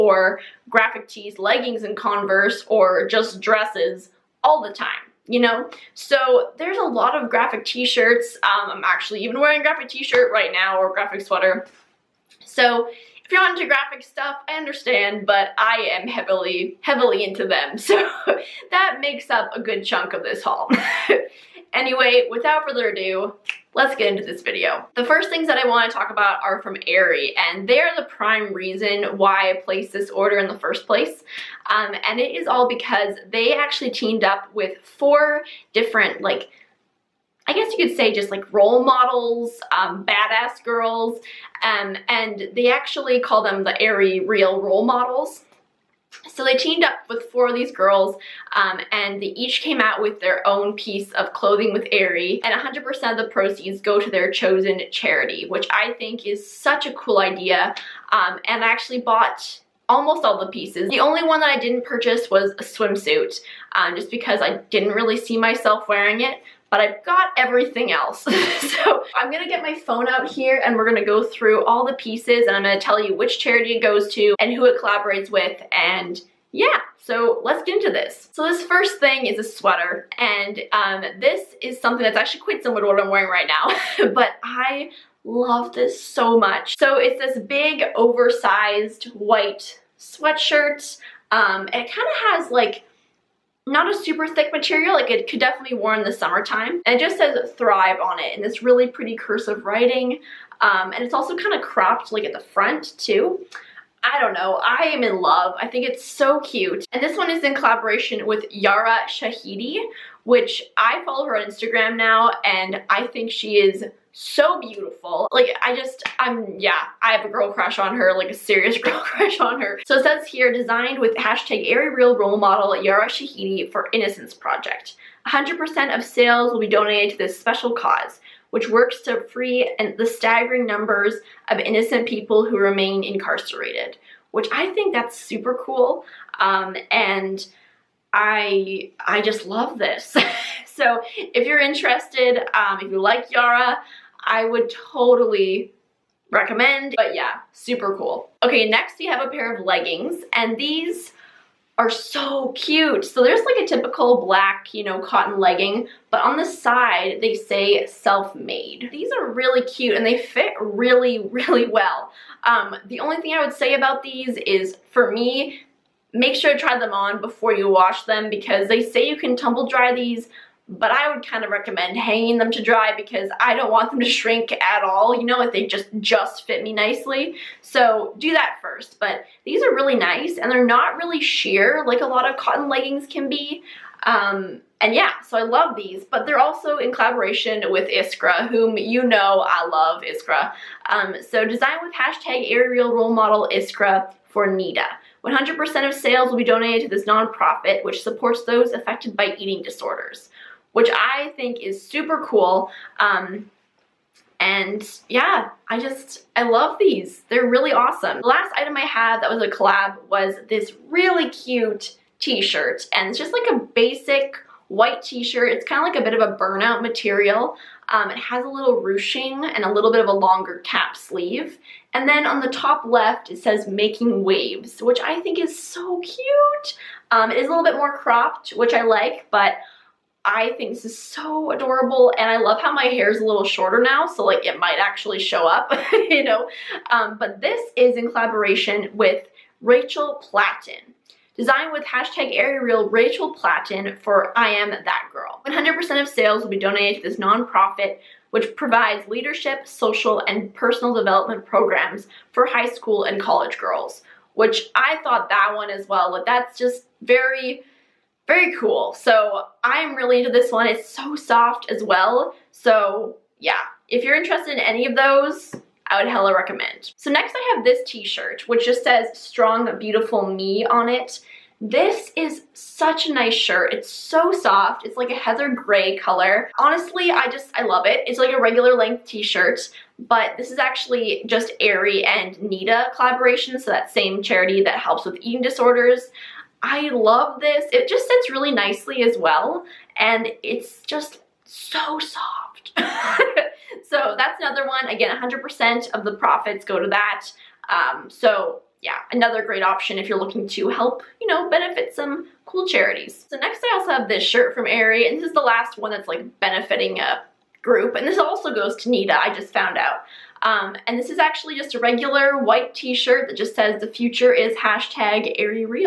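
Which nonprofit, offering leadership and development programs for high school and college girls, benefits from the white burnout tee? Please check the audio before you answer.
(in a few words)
I Am That Girl.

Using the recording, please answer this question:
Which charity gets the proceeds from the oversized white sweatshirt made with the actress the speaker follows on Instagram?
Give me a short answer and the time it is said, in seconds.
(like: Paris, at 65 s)
Innocence Project, at 123 s.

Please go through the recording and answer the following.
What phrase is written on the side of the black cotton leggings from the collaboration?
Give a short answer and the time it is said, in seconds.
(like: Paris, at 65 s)
Self-made, at 157 s.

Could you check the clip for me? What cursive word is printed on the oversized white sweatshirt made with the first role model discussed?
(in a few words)
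Thrive.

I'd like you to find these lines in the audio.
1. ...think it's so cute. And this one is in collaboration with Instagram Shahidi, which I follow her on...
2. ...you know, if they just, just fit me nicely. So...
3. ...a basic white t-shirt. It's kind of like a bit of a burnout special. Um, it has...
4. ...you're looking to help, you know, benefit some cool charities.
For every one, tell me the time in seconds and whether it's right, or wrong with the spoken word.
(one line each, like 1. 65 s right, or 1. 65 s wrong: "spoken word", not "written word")
1. 105 s wrong: "Yara", not "Instagram"
2. 175 s right
3. 213 s wrong: "material", not "special"
4. 300 s right.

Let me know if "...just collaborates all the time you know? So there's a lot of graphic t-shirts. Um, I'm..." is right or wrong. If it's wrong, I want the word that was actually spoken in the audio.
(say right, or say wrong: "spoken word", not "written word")
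wrong: "dresses", not "collaborates".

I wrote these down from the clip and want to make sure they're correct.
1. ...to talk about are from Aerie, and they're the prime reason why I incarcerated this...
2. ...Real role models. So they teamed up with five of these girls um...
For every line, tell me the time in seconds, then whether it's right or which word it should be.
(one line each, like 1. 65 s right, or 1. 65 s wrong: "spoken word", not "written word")
1. 25 s wrong: "placed", not "incarcerated"
2. 44 s wrong: "four", not "five".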